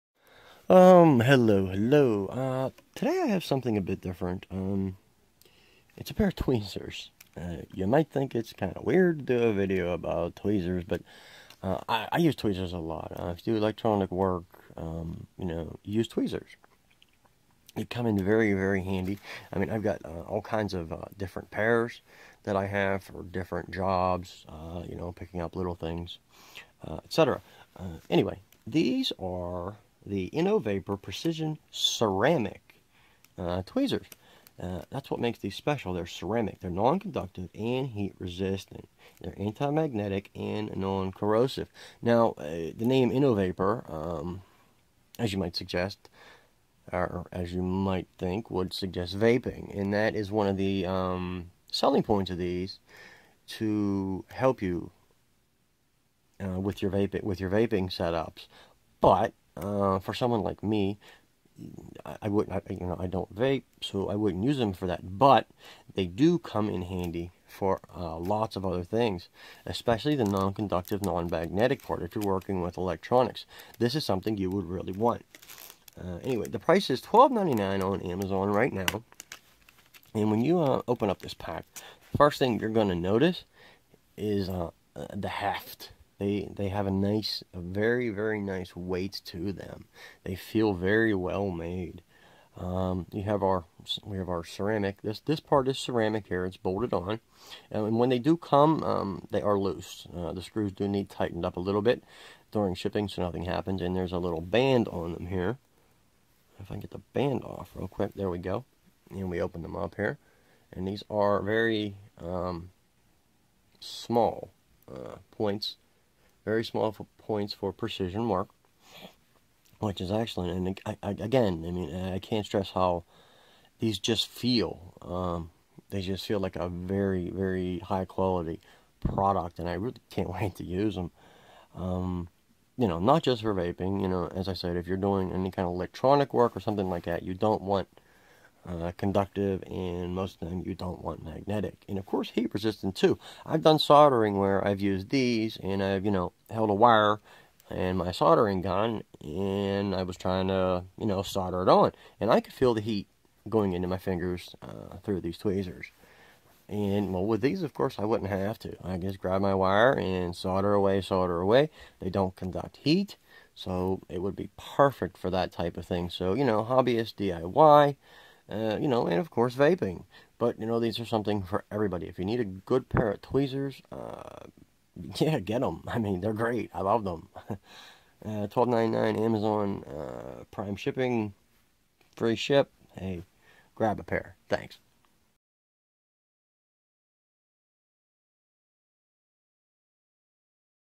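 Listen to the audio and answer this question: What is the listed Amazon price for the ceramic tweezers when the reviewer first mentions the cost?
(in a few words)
$12.99.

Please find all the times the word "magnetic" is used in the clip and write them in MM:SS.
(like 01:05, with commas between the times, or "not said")
00:39, 01:11, 02:21.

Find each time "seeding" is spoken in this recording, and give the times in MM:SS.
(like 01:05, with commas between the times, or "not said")
not said.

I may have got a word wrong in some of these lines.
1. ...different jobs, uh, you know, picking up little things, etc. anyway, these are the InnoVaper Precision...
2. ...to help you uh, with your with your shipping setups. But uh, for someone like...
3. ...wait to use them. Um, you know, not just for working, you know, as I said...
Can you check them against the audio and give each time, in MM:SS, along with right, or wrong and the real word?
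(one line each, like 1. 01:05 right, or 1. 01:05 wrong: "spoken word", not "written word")
1. 00:23 right
2. 00:53 wrong: "vaping", not "shipping"
3. 02:10 wrong: "vaping", not "working".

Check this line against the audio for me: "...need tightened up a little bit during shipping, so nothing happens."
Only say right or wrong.
right.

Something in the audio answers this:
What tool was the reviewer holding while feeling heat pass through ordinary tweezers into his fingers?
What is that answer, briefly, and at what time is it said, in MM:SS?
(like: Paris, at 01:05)
Soldering gun, at 02:28.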